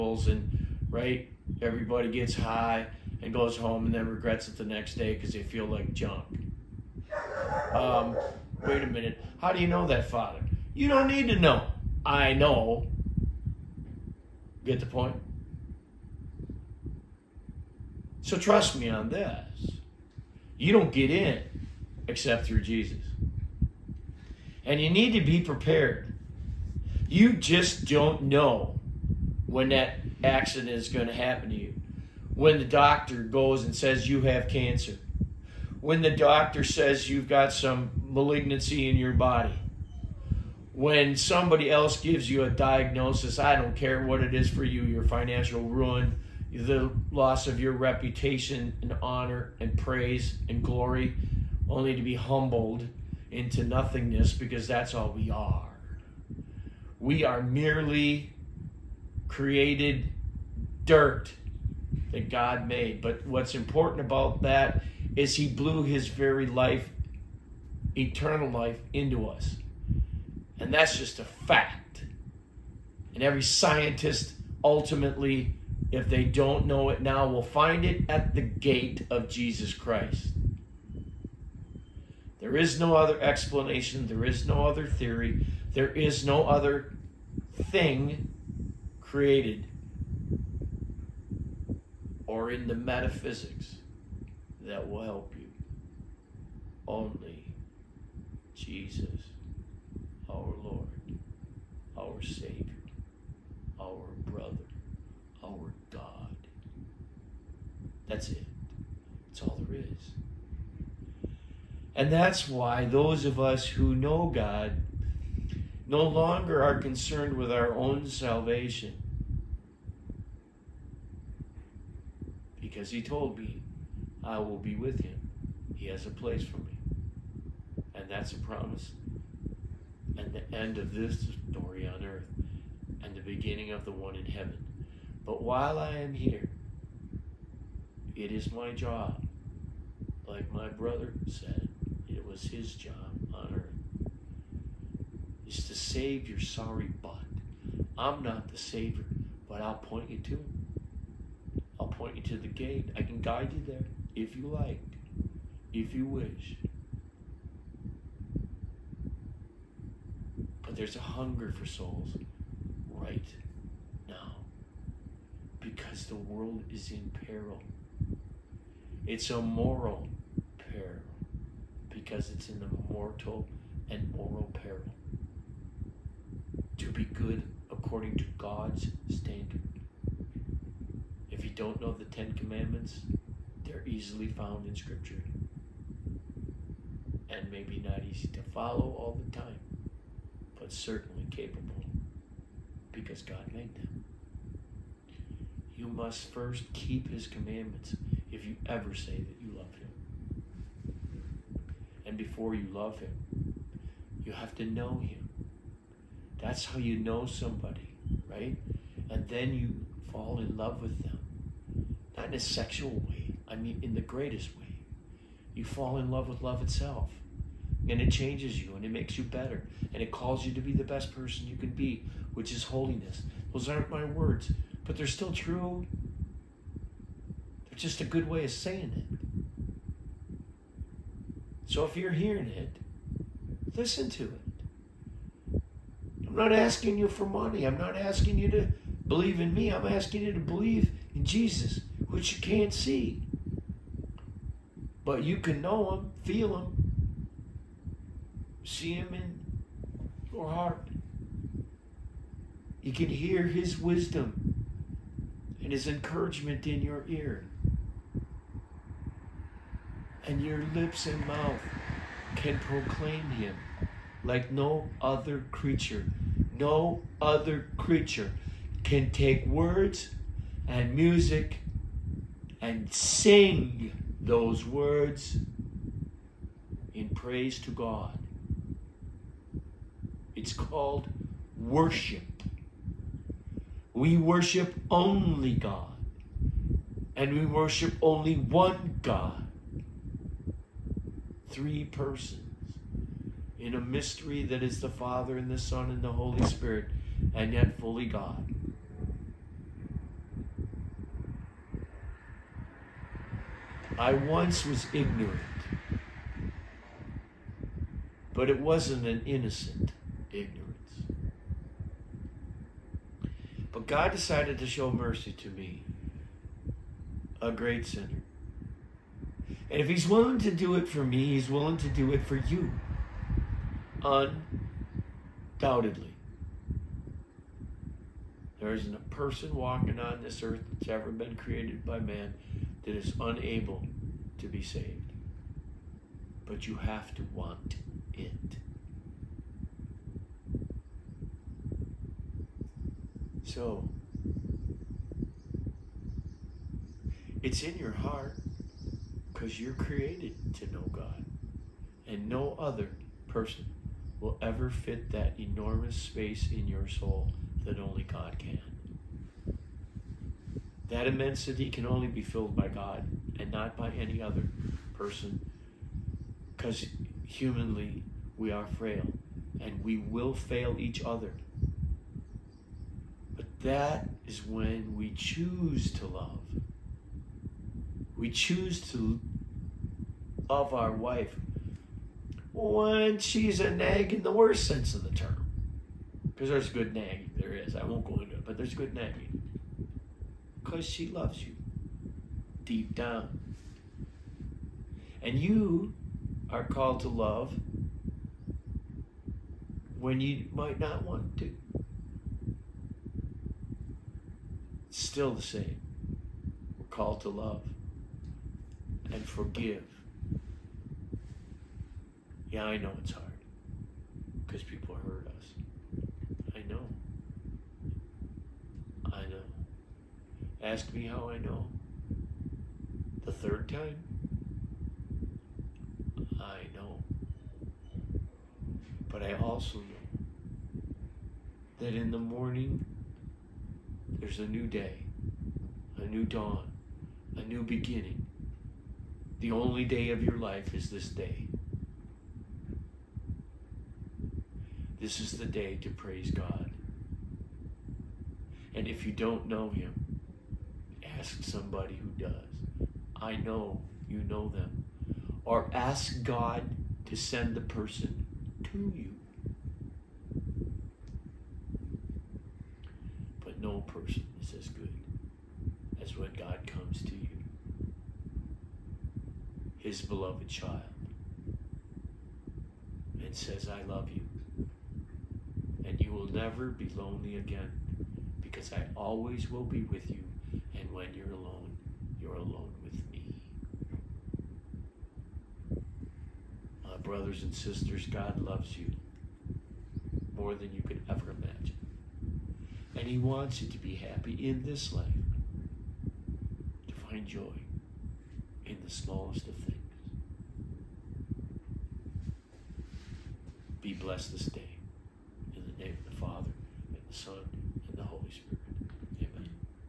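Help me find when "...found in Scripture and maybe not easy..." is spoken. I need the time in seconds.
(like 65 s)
184 s.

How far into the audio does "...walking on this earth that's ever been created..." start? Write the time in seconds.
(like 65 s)
329 s.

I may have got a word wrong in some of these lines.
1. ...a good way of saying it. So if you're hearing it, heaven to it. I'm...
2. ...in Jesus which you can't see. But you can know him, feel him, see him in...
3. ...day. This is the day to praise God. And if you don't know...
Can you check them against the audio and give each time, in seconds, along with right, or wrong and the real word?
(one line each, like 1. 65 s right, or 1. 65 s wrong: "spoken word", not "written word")
1. 228 s wrong: "listen", not "heaven"
2. 241 s right
3. 441 s right.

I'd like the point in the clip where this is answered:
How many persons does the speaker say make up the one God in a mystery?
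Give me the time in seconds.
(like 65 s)
291 s.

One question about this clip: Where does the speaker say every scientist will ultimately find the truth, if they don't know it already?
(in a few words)
the gate of Jesus Christ.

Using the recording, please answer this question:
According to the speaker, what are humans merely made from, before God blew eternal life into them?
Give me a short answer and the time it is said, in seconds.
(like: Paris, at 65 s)
dirt, at 60 s.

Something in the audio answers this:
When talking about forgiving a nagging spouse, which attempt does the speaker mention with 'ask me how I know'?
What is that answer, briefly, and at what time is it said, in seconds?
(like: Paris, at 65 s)
the third time, at 423 s.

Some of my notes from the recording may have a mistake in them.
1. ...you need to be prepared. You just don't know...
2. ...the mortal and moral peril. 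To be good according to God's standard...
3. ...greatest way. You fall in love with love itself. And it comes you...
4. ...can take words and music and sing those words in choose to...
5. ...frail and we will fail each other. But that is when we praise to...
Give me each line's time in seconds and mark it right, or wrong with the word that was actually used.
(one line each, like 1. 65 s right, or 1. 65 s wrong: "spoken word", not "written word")
1. 24 s right
2. 172 s right
3. 214 s wrong: "changes", not "comes"
4. 268 s wrong: "praise", not "choose"
5. 368 s wrong: "choose", not "praise".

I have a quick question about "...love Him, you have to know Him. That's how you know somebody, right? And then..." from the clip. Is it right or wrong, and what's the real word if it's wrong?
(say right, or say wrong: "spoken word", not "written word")
right.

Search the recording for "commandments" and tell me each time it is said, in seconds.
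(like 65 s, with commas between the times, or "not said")
182 s, 197 s.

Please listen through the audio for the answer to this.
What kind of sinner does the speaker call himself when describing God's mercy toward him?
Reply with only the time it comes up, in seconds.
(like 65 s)
317 s.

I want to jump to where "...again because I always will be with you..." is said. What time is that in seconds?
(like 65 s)
477 s.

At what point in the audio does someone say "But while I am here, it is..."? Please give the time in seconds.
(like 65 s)
135 s.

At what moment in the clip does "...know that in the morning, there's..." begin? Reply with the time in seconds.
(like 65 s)
429 s.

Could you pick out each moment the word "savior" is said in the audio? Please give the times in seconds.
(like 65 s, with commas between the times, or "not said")
102 s, 148 s.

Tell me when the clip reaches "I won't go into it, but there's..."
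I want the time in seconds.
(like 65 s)
387 s.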